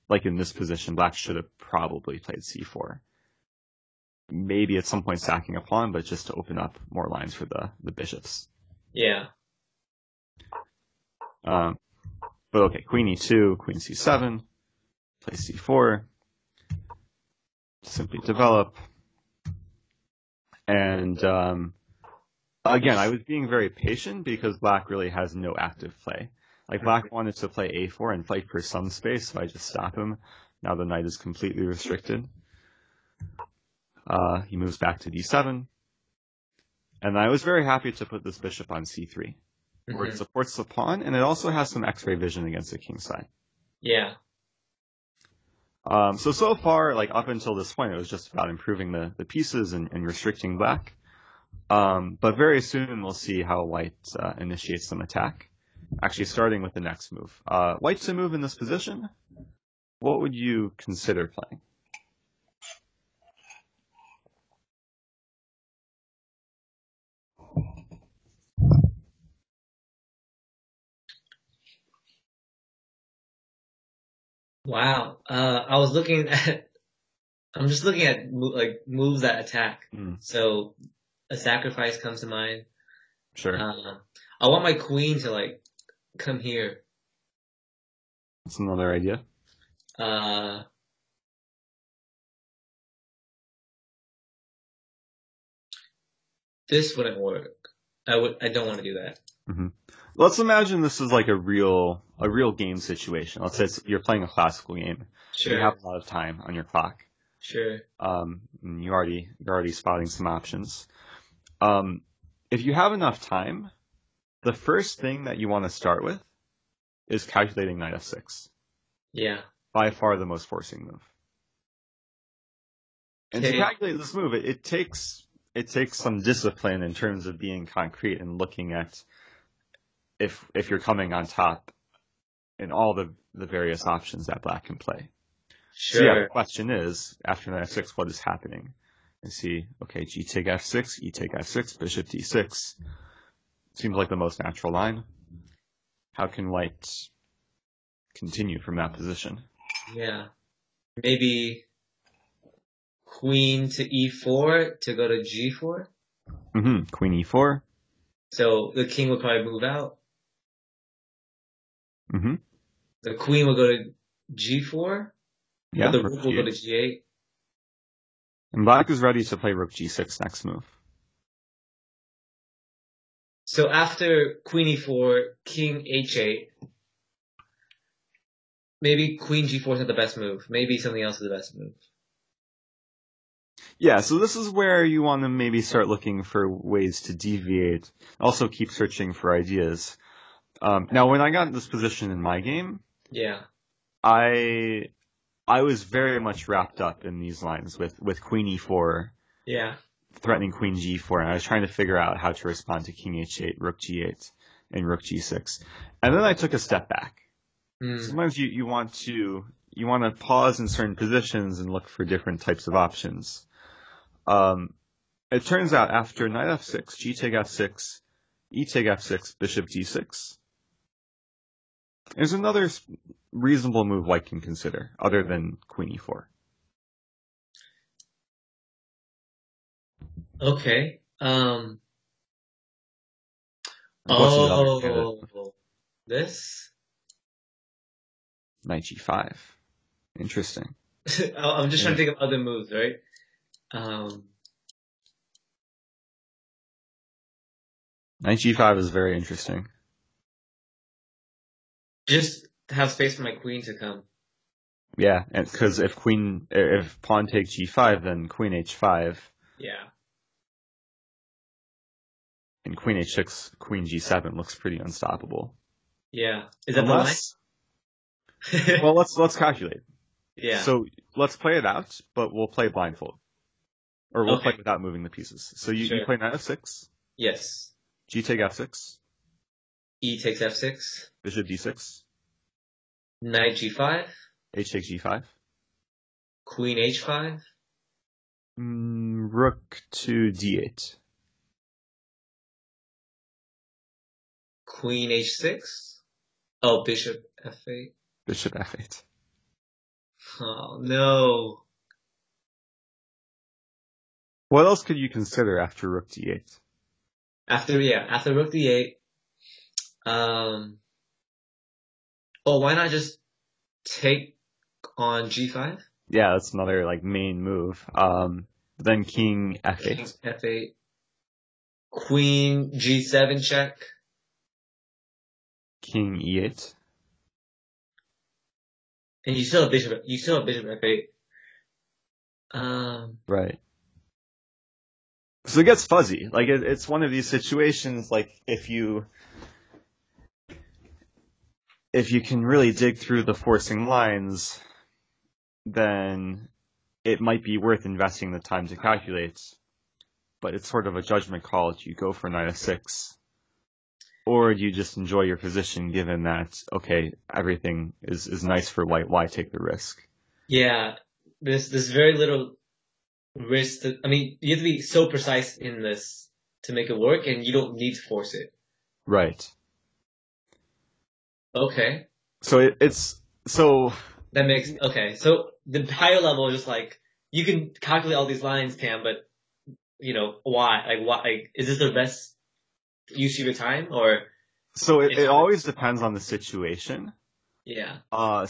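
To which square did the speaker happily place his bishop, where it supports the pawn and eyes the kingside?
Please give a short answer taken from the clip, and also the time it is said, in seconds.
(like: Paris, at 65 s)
c3, at 38 s.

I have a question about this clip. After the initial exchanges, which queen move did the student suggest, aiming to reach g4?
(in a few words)
queen e4.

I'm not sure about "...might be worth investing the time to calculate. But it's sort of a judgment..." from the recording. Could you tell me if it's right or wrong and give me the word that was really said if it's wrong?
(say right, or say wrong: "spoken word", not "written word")
right.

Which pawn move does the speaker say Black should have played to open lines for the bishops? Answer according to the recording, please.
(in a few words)
c4.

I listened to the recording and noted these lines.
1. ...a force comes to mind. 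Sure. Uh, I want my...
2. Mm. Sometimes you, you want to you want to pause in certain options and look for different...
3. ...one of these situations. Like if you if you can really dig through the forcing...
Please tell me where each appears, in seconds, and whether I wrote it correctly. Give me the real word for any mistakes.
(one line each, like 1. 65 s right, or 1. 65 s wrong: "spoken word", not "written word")
1. 81 s wrong: "sacrifice", not "force"
2. 207 s wrong: "positions", not "options"
3. 336 s right.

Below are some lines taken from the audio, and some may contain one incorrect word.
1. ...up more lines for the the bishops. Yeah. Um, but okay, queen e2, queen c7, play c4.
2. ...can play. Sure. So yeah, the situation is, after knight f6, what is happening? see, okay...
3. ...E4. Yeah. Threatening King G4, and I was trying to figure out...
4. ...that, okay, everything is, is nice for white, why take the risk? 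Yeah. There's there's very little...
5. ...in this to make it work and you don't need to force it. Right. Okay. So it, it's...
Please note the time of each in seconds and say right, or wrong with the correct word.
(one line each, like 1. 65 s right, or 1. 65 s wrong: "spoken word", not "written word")
1. 6 s right
2. 134 s wrong: "question", not "situation"
3. 198 s wrong: "Queen", not "King"
4. 356 s right
5. 365 s right.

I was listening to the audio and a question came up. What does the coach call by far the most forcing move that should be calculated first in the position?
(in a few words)
knight f6.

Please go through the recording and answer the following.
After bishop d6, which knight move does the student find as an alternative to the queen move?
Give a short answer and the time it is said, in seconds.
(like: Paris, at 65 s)
Knight g5, at 238 s.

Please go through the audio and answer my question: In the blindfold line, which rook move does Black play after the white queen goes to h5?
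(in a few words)
rook d8.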